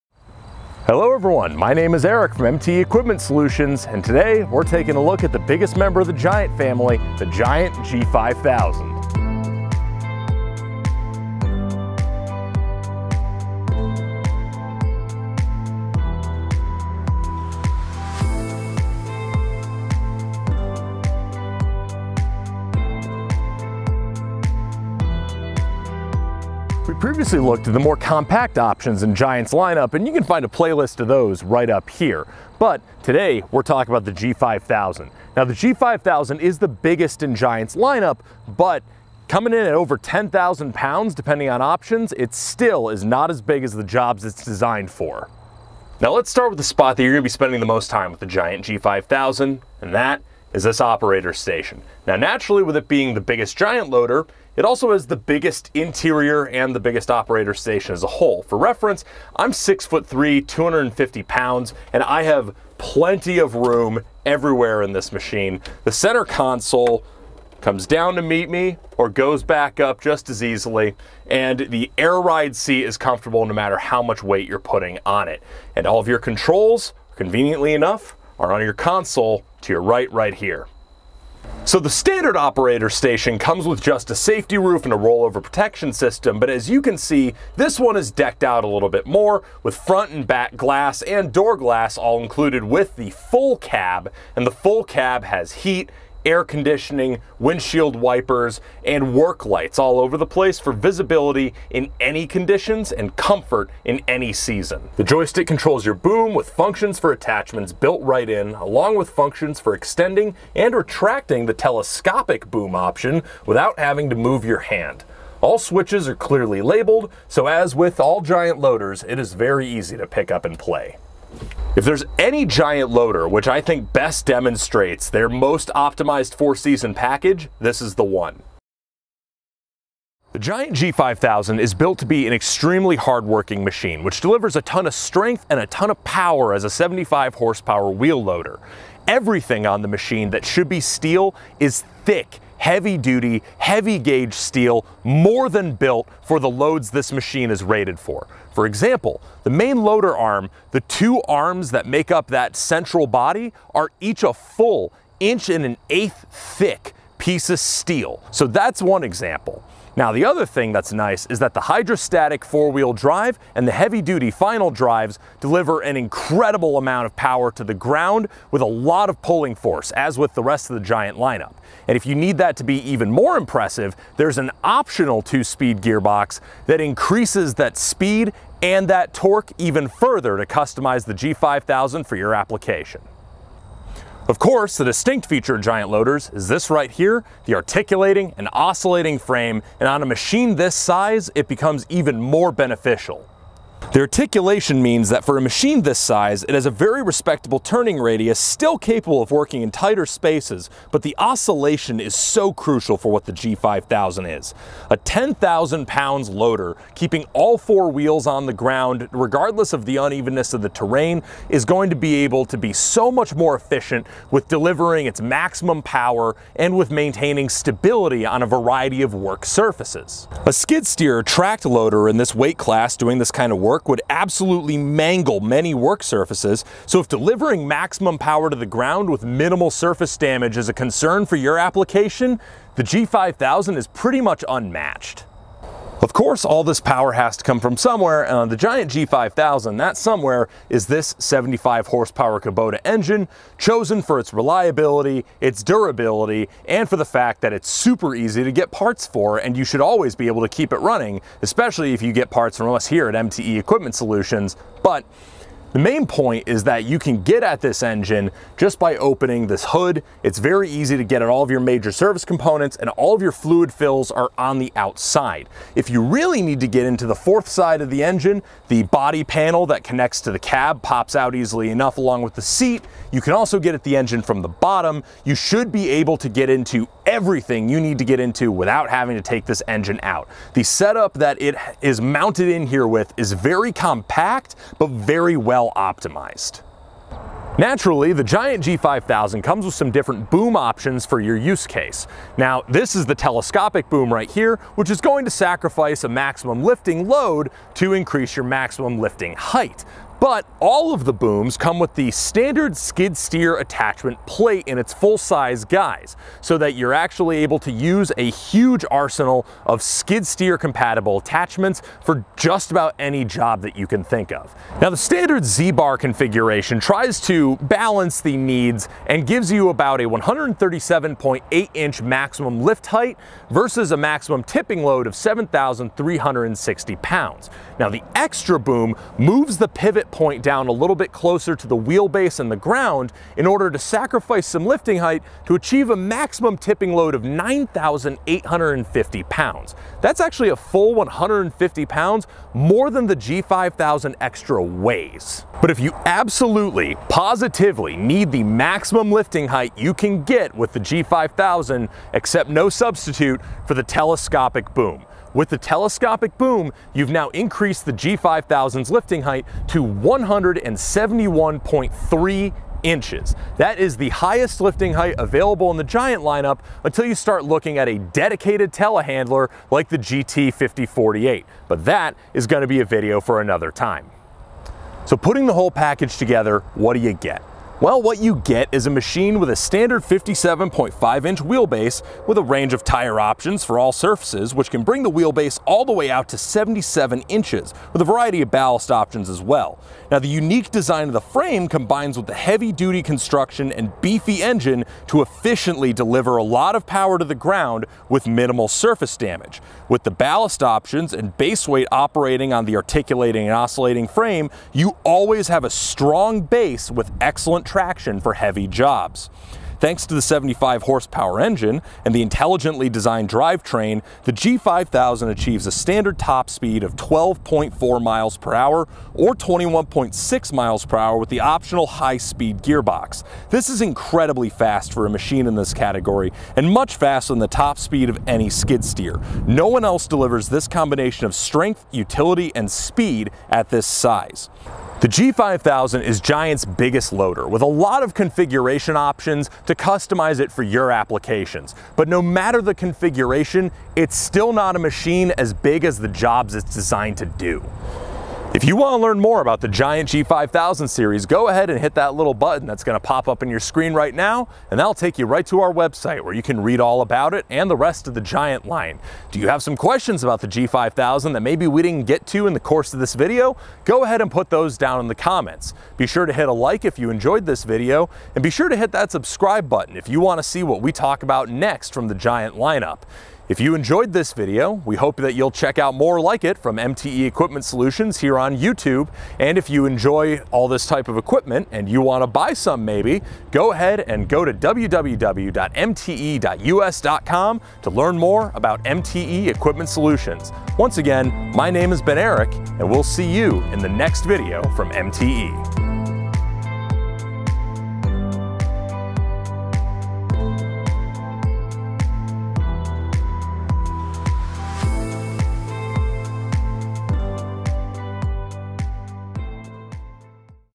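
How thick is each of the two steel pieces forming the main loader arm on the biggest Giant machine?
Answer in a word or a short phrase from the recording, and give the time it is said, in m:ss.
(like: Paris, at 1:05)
1 1/8 inch, at 2:34.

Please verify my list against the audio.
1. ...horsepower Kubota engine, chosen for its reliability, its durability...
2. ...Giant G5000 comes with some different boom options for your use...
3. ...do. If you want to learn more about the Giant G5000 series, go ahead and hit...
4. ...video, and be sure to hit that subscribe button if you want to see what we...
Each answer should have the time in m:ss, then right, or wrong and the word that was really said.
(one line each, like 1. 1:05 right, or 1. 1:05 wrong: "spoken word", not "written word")
1. 4:01 right
2. 4:48 right
3. 7:27 right
4. 7:47 right.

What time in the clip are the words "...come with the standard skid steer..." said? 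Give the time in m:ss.
5:01.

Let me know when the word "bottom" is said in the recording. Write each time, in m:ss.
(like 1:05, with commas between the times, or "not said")
4:34.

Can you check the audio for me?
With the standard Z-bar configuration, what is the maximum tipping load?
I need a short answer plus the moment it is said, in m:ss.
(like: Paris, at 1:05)
7,360 pounds, at 5:25.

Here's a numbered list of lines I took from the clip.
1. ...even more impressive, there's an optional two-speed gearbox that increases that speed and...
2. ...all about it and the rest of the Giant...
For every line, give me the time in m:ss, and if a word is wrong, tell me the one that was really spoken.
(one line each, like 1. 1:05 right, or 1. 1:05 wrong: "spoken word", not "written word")
1. 2:52 right
2. 7:36 right.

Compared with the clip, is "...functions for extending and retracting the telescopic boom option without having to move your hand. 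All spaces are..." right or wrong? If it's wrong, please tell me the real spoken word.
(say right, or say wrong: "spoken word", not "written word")
wrong: "switches", not "spaces".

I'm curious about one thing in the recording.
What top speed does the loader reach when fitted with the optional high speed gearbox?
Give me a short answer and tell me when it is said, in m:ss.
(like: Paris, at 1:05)
21.6 mph, at 6:59.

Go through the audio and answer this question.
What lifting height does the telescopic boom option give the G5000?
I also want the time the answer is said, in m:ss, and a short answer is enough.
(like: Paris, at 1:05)
171.3 inches, at 5:59.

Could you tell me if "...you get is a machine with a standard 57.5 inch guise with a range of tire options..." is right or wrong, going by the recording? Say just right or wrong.
wrong.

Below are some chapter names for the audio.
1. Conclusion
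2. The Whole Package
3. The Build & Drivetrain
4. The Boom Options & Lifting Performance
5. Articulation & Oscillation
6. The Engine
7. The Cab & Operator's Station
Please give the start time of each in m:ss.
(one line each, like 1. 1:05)
1. 7:28
2. 6:15
3. 2:10
4. 4:47
5. 3:02
6. 3:55
7. 0:45.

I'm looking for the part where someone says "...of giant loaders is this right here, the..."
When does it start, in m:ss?
3:05.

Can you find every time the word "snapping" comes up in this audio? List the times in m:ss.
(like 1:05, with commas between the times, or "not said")
not said.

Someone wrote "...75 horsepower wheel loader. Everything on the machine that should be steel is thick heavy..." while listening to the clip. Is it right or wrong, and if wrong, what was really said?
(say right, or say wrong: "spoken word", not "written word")
right.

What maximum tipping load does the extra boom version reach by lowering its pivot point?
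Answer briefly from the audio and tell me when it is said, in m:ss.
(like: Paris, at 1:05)
9,850 pounds, at 5:37.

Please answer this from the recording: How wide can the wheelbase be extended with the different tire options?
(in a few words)
77 inches.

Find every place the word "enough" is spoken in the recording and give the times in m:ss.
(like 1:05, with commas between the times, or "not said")
1:17, 4:31.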